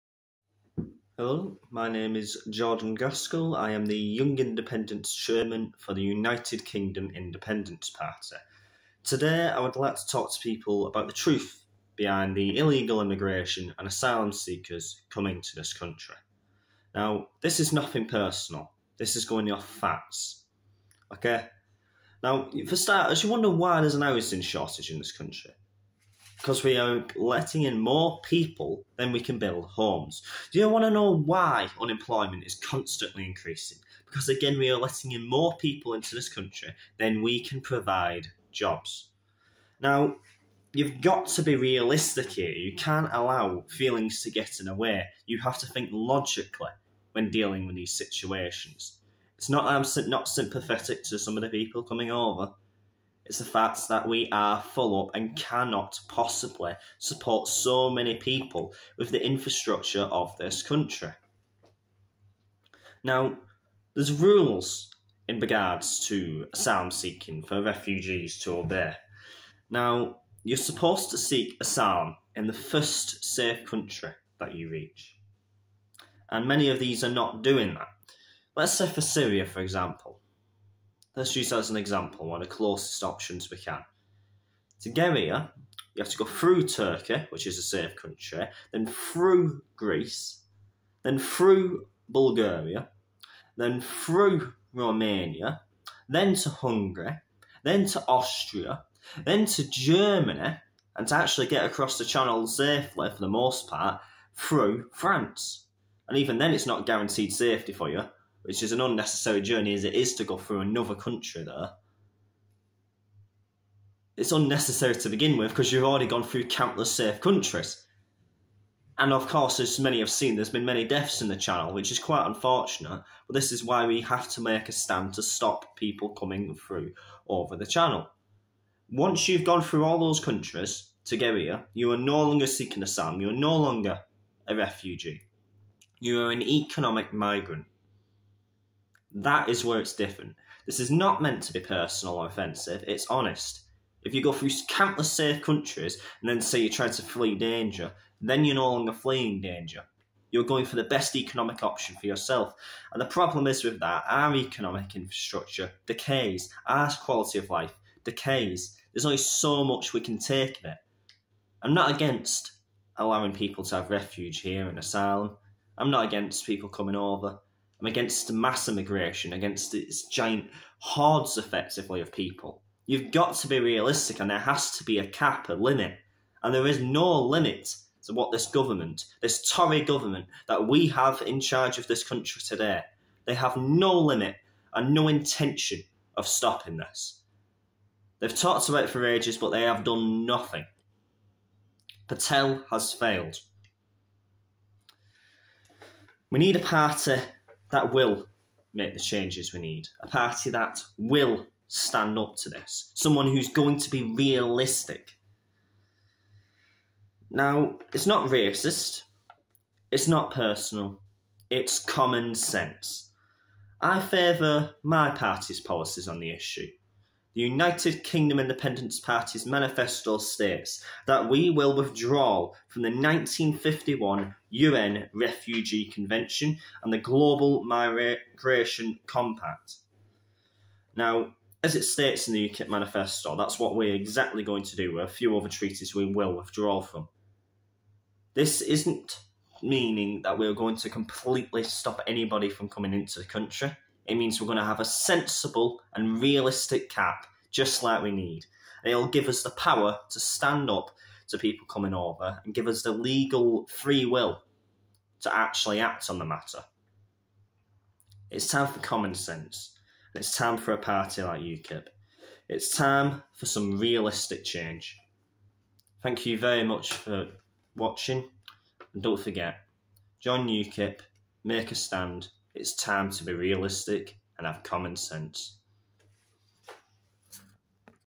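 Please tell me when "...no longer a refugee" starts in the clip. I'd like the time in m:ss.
2:13.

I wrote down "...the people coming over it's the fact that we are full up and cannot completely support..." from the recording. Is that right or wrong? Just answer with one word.
wrong.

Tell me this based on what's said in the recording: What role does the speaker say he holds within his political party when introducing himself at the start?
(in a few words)
Young Independence Chairman.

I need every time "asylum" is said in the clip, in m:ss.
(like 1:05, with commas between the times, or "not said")
0:13, 1:06, 1:11, 2:12, 2:44.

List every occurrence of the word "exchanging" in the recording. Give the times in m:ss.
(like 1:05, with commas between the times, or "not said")
not said.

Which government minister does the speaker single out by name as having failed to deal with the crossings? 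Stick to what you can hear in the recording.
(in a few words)
Patel.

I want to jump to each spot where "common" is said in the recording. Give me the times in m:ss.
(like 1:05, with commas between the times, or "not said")
3:31, 4:18, 4:34.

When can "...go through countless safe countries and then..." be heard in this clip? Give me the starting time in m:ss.
2:24.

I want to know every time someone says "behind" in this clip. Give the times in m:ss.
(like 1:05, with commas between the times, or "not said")
0:11.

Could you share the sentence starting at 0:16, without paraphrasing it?
Now, this is nothing personal, this is going off facts.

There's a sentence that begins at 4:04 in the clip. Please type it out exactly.
It means we're going to have a sensible and realistic cap, just like we need.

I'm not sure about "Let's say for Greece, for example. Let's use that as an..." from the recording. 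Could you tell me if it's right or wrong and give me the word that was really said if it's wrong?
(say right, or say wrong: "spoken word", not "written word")
wrong: "Syria", not "Greece".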